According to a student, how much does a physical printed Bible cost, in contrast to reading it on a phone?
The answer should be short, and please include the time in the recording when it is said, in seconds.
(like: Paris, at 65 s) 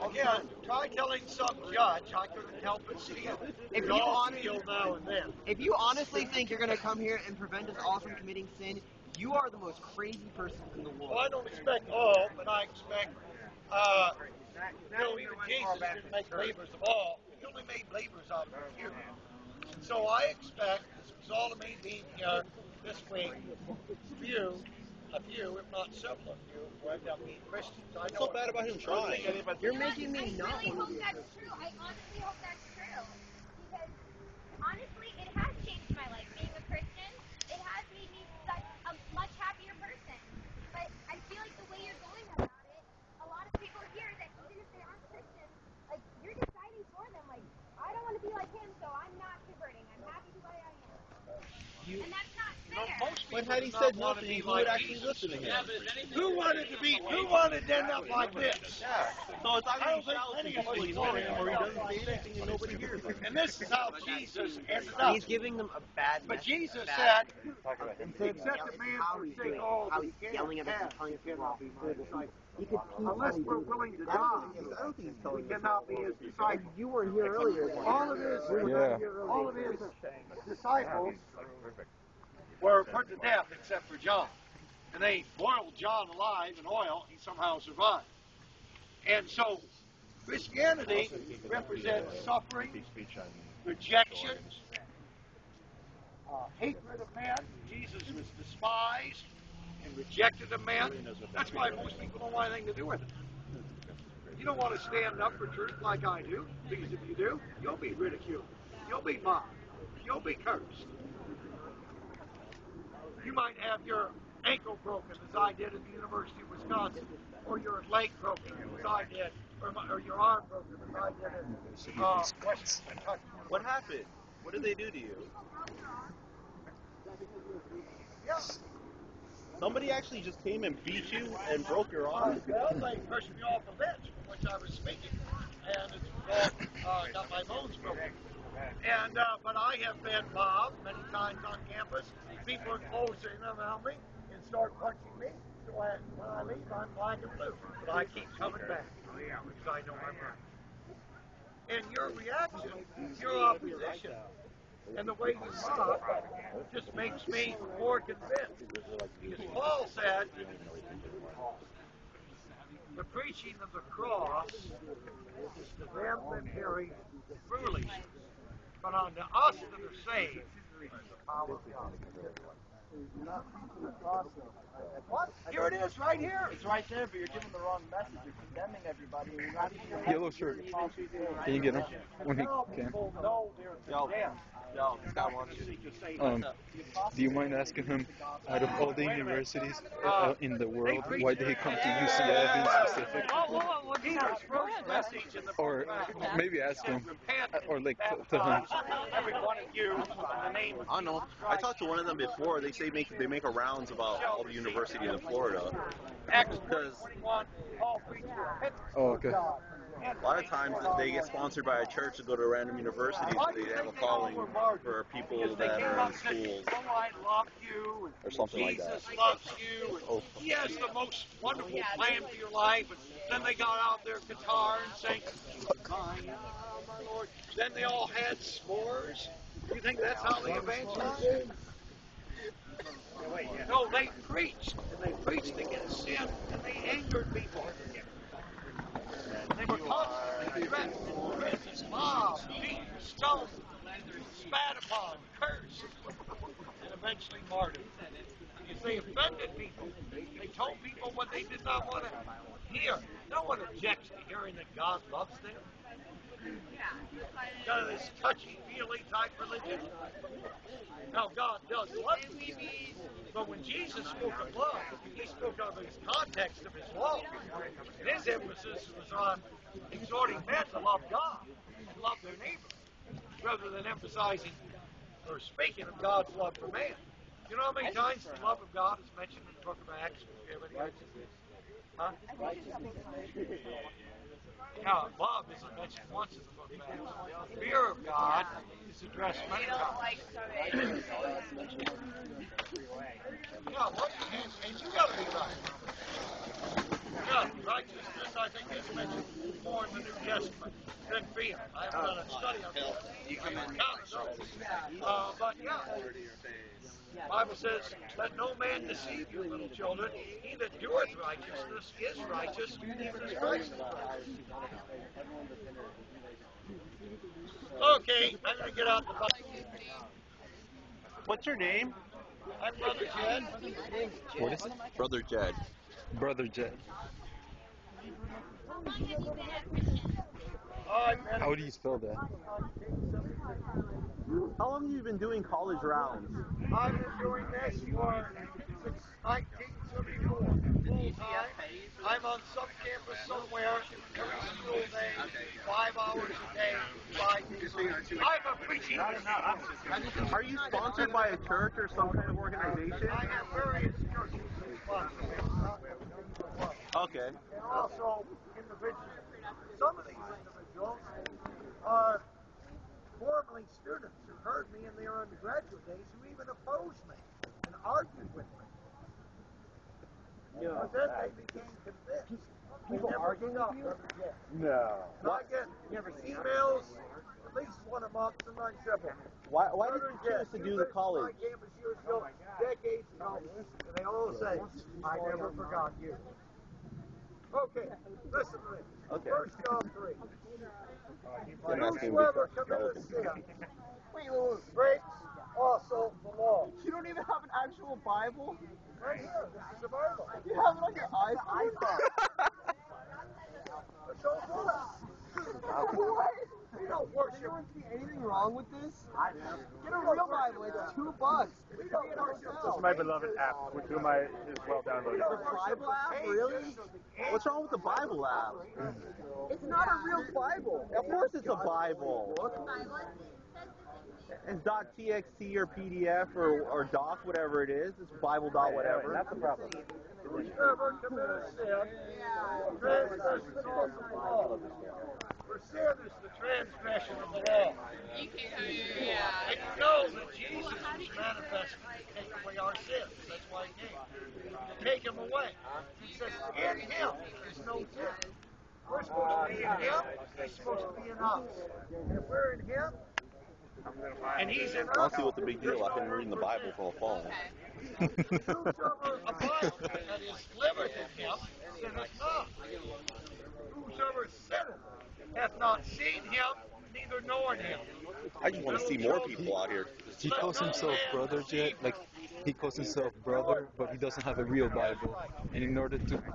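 2 dollars, at 410 s.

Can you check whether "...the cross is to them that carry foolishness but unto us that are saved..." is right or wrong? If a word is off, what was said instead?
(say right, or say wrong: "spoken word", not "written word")
right.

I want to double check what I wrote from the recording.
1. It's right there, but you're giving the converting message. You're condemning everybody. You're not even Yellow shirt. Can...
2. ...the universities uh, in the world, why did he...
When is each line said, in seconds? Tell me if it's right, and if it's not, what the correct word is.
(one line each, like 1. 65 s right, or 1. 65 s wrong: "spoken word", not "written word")
1. 176 s wrong: "wrong", not "converting"
2. 188 s right.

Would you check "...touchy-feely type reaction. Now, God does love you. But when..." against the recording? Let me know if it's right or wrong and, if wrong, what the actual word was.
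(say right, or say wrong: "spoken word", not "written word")
wrong: "religion", not "reaction".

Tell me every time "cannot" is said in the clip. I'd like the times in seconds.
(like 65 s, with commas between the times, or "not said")
71 s, 75 s.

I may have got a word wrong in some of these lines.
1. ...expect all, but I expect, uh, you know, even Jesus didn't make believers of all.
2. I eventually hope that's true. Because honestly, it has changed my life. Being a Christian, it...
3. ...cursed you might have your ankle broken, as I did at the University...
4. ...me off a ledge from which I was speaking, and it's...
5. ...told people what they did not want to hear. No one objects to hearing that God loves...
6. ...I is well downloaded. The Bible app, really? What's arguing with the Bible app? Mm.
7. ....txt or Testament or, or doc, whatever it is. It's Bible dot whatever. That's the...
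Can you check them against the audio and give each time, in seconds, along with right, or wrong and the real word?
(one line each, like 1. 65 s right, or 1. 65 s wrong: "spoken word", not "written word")
1. 11 s right
2. 31 s wrong: "honestly", not "eventually"
3. 110 s right
4. 133 s right
5. 250 s right
6. 414 s wrong: "wrong", not "arguing"
7. 424 s wrong: "PDF", not "Testament".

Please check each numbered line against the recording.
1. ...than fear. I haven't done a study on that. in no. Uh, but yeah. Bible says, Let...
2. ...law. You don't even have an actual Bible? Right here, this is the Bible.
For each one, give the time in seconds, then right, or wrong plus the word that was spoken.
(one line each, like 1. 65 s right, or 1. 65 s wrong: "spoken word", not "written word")
1. 301 s right
2. 396 s right.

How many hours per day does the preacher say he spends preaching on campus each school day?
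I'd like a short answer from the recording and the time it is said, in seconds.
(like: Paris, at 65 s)
5, at 345 s.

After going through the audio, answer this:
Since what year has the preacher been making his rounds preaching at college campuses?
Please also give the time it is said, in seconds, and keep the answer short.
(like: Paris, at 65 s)
1974, at 339 s.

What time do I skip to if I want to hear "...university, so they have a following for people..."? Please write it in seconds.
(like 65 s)
212 s.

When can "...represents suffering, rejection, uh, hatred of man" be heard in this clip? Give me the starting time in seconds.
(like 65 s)
91 s.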